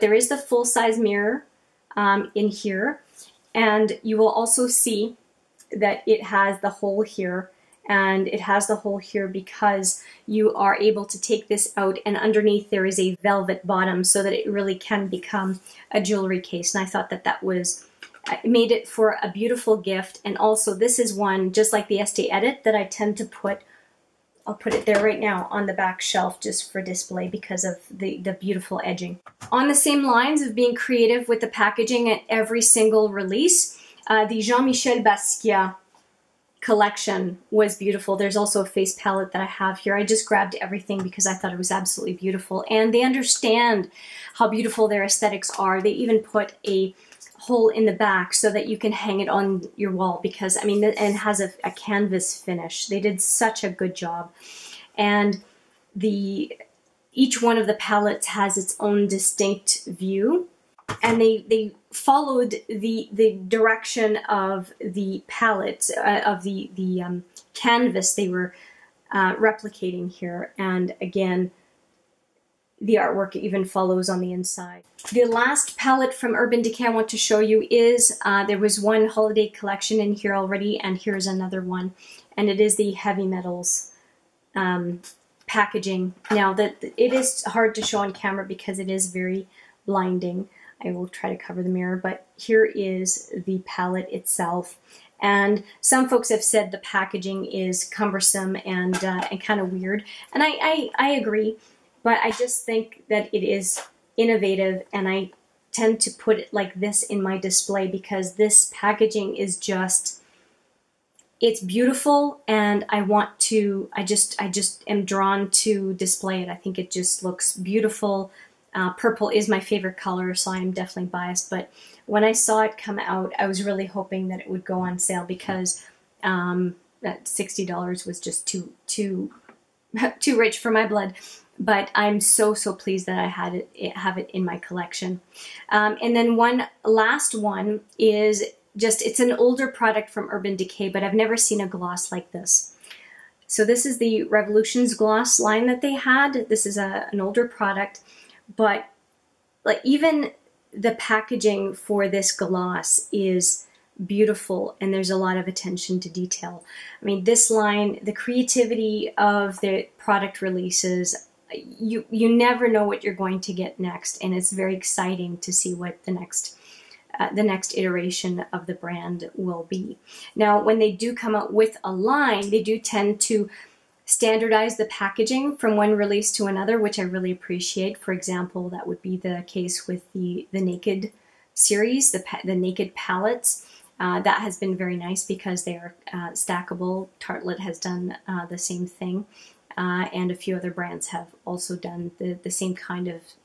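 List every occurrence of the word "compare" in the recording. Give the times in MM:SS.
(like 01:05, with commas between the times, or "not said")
not said.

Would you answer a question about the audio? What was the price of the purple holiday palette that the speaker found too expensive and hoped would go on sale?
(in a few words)
$60.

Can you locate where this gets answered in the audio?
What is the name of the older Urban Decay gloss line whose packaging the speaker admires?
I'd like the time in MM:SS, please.
02:24.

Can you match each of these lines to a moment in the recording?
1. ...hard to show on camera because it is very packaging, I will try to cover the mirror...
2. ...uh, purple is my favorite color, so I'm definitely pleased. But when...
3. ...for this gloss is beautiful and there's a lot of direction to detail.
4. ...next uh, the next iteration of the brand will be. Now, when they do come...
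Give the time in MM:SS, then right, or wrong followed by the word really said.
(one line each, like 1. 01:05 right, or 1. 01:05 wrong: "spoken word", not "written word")
1. 01:27 wrong: "blinding", not "packaging"
2. 01:58 wrong: "biased", not "pleased"
3. 02:31 wrong: "attention", not "direction"
4. 02:46 right.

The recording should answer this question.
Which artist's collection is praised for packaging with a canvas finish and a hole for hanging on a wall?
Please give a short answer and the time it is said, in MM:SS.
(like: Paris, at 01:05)
Jean-Michel Basquiat, at 00:34.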